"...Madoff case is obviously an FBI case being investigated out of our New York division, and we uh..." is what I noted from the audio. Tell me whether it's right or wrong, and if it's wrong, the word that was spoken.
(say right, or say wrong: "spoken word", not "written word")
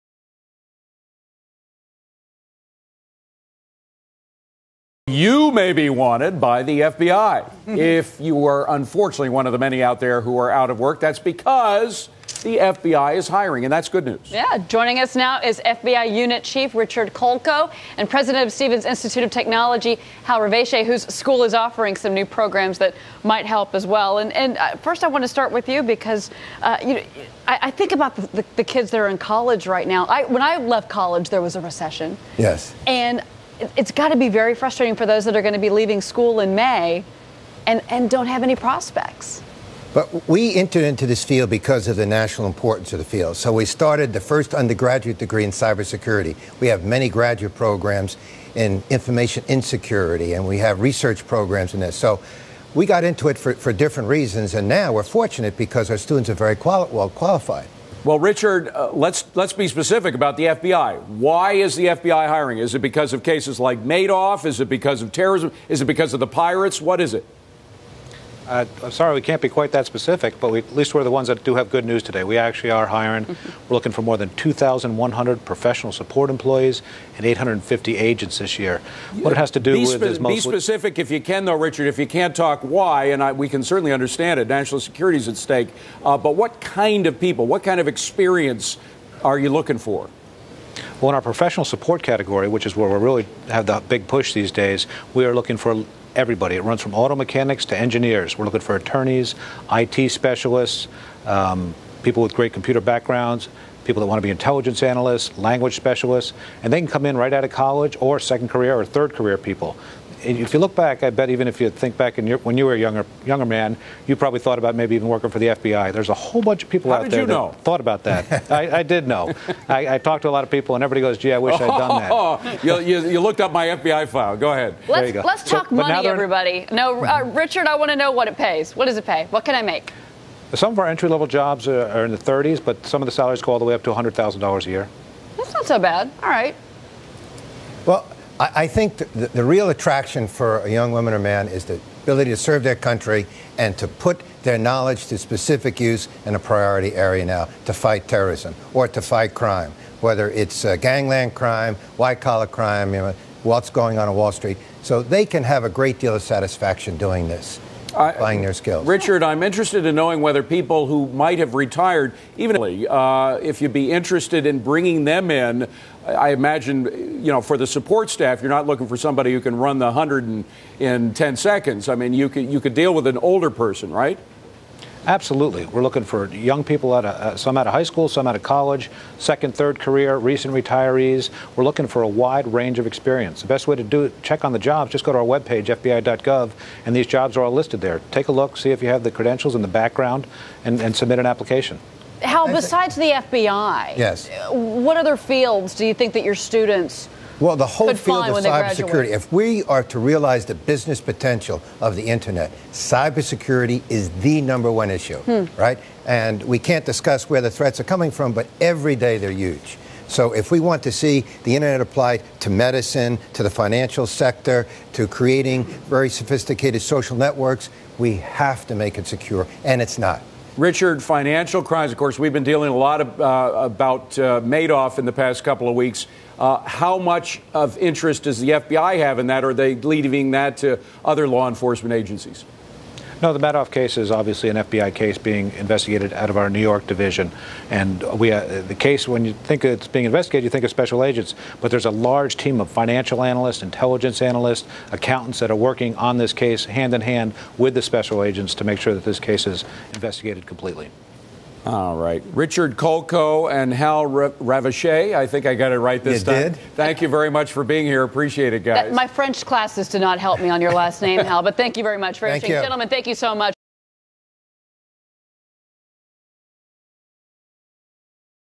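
right.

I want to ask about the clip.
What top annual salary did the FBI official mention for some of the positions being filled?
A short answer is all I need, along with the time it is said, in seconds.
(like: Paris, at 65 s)
$100,000, at 133 s.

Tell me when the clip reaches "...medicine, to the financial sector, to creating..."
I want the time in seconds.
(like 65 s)
212 s.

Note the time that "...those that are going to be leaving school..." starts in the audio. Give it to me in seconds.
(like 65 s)
35 s.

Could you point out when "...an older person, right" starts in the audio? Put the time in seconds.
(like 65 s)
173 s.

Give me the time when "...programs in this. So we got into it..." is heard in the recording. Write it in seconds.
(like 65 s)
51 s.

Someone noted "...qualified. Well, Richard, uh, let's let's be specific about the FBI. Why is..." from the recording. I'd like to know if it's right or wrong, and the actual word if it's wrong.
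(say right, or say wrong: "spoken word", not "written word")
right.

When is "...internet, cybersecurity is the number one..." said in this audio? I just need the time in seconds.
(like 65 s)
202 s.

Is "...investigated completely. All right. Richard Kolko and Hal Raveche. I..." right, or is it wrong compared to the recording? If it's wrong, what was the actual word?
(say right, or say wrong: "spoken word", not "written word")
right.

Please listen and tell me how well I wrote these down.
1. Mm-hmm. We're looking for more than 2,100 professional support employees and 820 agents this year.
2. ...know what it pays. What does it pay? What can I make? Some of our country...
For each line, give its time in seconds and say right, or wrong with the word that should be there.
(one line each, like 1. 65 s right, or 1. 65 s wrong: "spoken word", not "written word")
1. 73 s wrong: "850", not "820"
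2. 127 s wrong: "entry", not "country".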